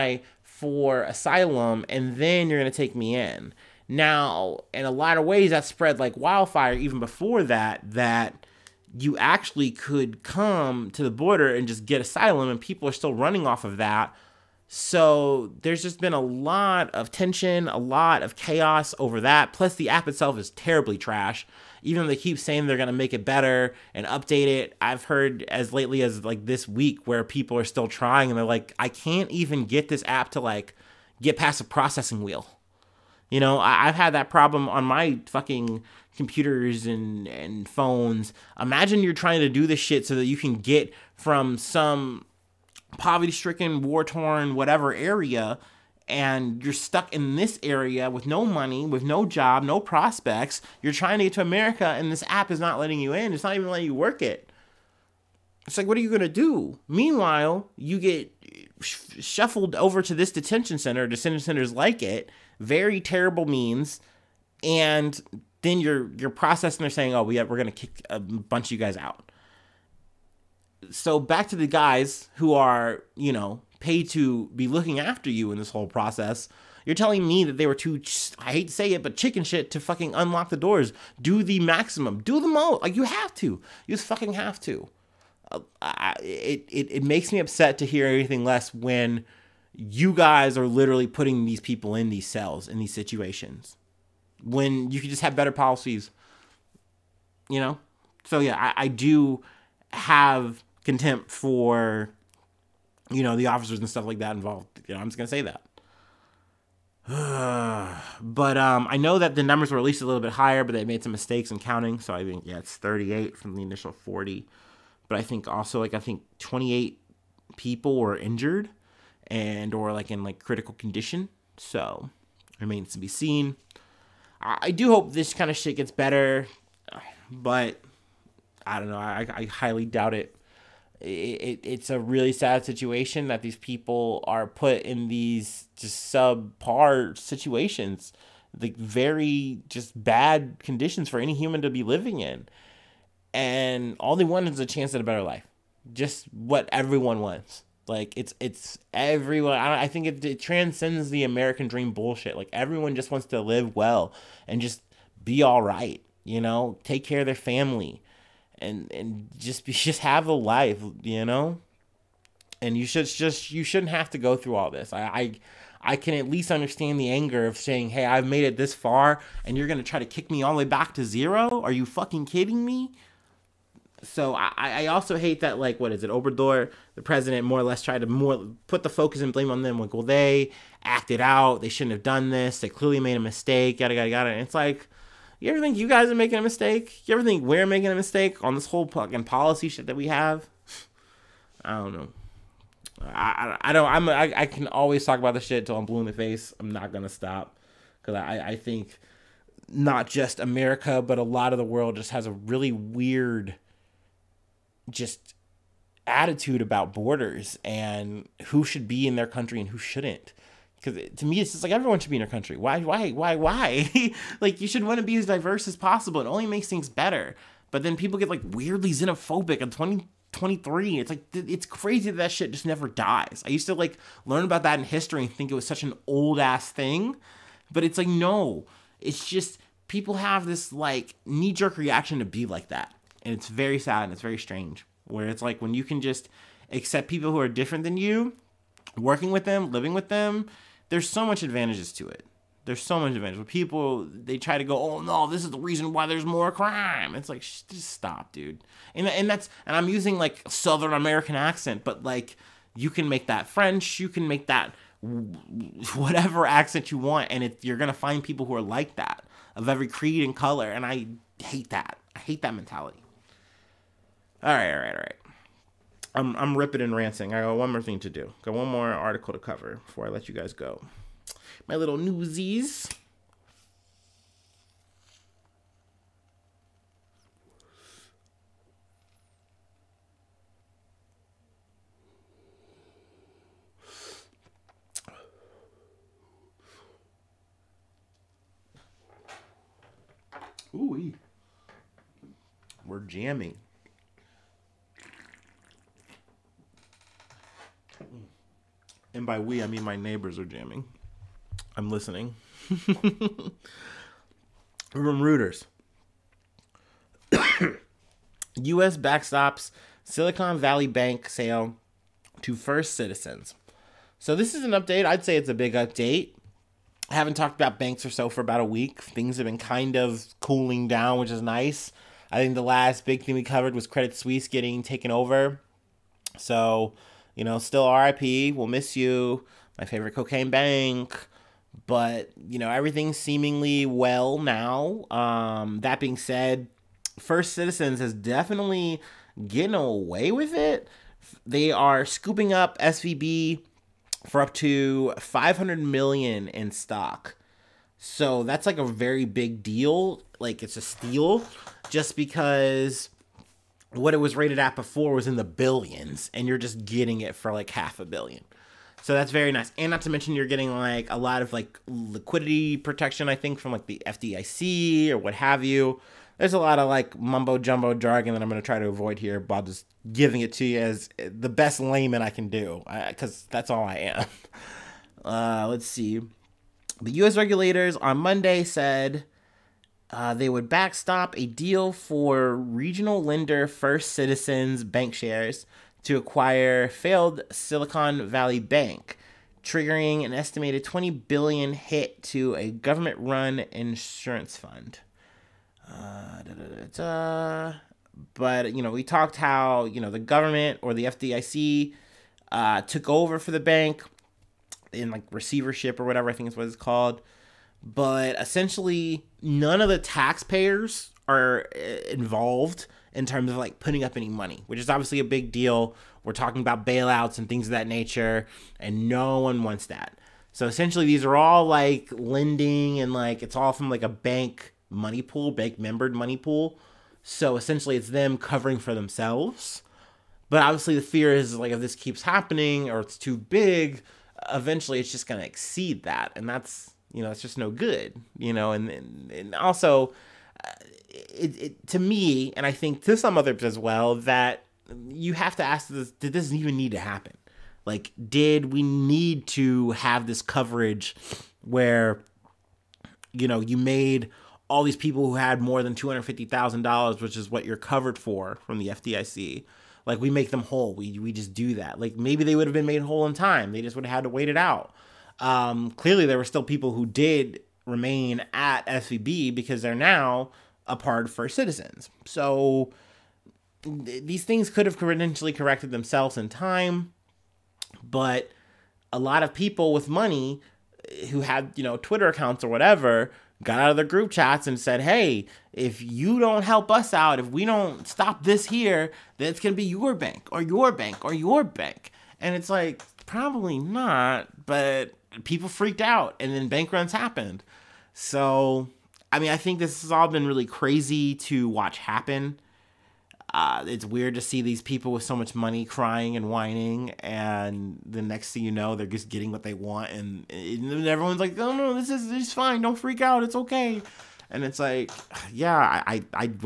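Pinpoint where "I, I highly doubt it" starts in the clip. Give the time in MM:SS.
02:08.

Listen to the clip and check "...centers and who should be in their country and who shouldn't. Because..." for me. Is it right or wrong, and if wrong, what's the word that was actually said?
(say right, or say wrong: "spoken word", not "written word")
wrong: "borders", not "centers".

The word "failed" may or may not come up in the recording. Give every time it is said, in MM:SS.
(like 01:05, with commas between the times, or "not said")
06:26.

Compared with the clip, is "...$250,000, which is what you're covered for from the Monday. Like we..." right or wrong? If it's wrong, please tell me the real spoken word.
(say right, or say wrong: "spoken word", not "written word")
wrong: "FDIC", not "Monday".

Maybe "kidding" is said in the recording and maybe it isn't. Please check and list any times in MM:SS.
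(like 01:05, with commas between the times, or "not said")
02:52.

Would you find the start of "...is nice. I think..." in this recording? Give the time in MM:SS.
05:21.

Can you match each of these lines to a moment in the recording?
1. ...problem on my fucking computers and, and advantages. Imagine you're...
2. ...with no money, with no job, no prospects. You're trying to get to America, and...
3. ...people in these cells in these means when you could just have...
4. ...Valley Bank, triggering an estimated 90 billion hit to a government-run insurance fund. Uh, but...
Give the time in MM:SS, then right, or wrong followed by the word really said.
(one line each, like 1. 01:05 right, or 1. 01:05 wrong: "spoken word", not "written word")
1. 00:34 wrong: "phones", not "advantages"
2. 00:48 right
3. 01:31 wrong: "situations", not "means"
4. 06:28 wrong: "20", not "90".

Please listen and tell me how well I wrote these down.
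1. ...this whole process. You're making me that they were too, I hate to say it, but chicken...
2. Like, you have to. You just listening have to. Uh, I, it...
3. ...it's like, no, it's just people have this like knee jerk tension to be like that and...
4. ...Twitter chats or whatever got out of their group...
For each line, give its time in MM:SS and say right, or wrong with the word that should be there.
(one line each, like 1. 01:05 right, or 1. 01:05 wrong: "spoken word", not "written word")
1. 01:15 wrong: "telling", not "making"
2. 01:22 wrong: "fucking", not "listening"
3. 03:47 wrong: "reaction", not "tension"
4. 08:01 wrong: "accounts", not "chats".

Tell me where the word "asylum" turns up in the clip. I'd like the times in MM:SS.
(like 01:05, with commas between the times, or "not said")
00:01, 00:12.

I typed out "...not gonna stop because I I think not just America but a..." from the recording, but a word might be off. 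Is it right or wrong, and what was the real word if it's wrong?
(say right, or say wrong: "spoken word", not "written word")
right.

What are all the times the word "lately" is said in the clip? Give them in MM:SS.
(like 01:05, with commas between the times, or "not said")
00:25.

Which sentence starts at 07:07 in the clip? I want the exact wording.
So essentially, it's them covering for themselves.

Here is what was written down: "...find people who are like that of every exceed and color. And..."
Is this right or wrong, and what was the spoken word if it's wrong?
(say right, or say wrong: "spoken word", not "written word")
wrong: "creed", not "exceed".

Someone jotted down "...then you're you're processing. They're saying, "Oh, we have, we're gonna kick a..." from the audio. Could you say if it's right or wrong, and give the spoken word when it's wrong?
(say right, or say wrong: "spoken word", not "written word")
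right.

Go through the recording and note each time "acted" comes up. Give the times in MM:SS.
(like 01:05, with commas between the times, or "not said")
03:00.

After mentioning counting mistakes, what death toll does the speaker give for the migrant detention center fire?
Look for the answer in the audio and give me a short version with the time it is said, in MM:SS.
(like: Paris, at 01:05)
38, at 01:52.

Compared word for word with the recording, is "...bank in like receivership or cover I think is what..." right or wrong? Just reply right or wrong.
wrong.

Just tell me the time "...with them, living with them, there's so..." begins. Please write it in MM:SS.
03:59.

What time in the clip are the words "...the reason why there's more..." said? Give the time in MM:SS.
04:05.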